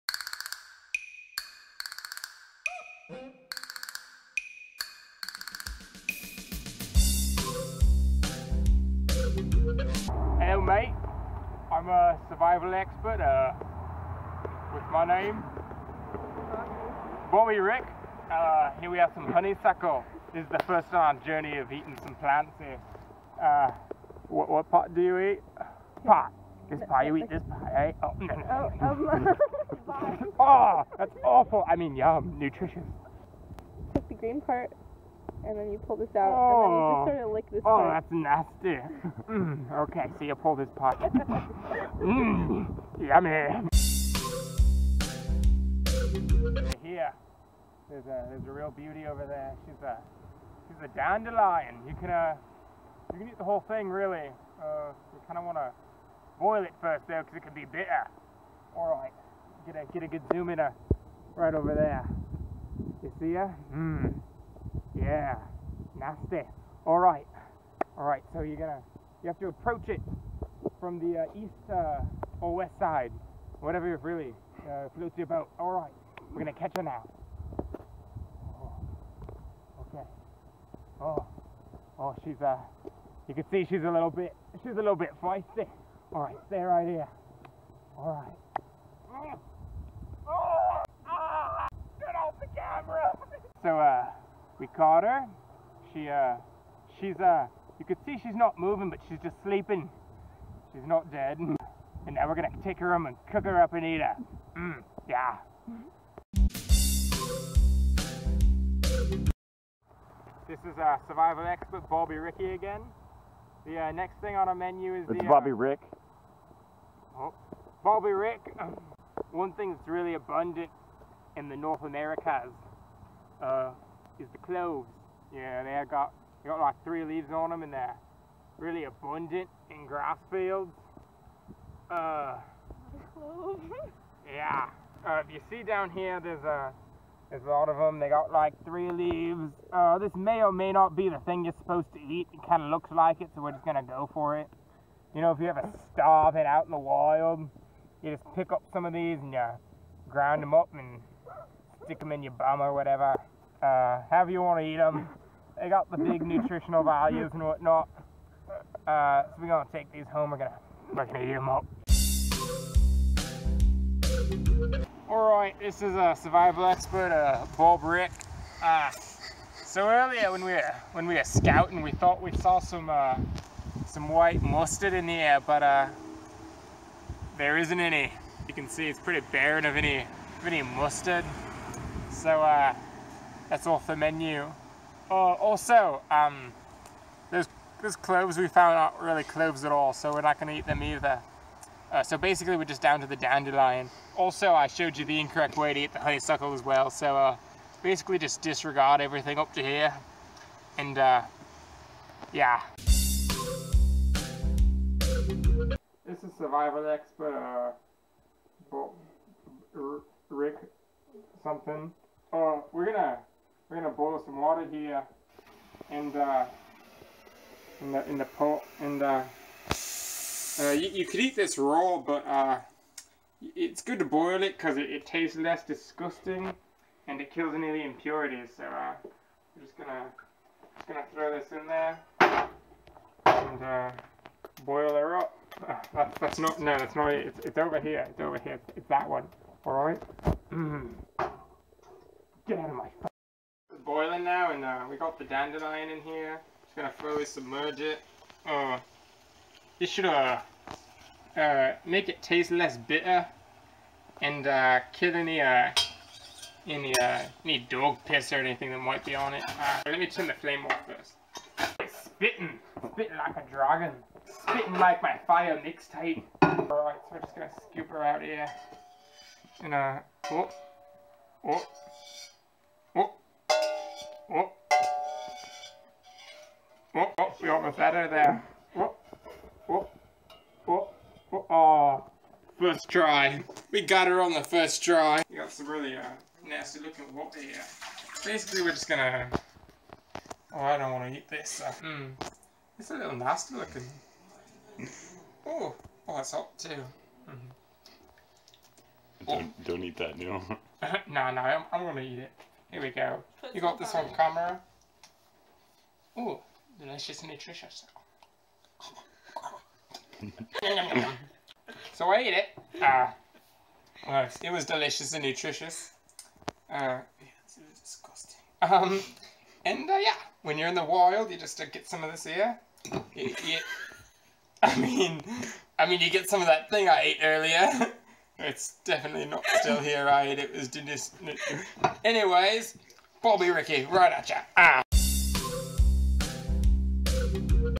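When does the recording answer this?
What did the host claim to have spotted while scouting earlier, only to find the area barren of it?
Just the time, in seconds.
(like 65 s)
174 s.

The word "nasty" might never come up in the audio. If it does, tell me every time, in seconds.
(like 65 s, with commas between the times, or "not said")
38 s, 65 s, 286 s, 293 s.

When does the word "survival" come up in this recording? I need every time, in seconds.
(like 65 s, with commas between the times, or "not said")
12 s, 111 s, 166 s, 206 s.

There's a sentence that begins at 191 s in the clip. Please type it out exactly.
Uh, so basically we're just down to the dandelion.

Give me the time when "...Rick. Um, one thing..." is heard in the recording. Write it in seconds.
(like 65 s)
118 s.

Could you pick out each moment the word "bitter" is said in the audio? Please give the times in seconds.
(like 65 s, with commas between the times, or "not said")
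57 s, 252 s.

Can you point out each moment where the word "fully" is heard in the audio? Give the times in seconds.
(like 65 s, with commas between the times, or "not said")
246 s.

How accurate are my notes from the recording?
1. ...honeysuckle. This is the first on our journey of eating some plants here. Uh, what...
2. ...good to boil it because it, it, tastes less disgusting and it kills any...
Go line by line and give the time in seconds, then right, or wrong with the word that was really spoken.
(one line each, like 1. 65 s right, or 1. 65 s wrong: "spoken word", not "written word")
1. 19 s right
2. 223 s right.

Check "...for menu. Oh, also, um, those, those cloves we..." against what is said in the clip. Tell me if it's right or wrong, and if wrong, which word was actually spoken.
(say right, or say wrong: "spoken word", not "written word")
right.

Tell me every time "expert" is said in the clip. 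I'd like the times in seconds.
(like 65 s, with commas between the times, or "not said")
12 s, 111 s, 166 s, 206 s.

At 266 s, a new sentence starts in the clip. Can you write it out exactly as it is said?
Alright, so we're just gonna scoop her out here.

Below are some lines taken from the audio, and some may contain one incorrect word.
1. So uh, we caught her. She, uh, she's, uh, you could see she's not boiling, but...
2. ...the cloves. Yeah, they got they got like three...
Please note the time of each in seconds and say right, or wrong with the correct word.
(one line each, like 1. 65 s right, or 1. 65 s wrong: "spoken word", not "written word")
1. 93 s wrong: "moving", not "boiling"
2. 124 s right.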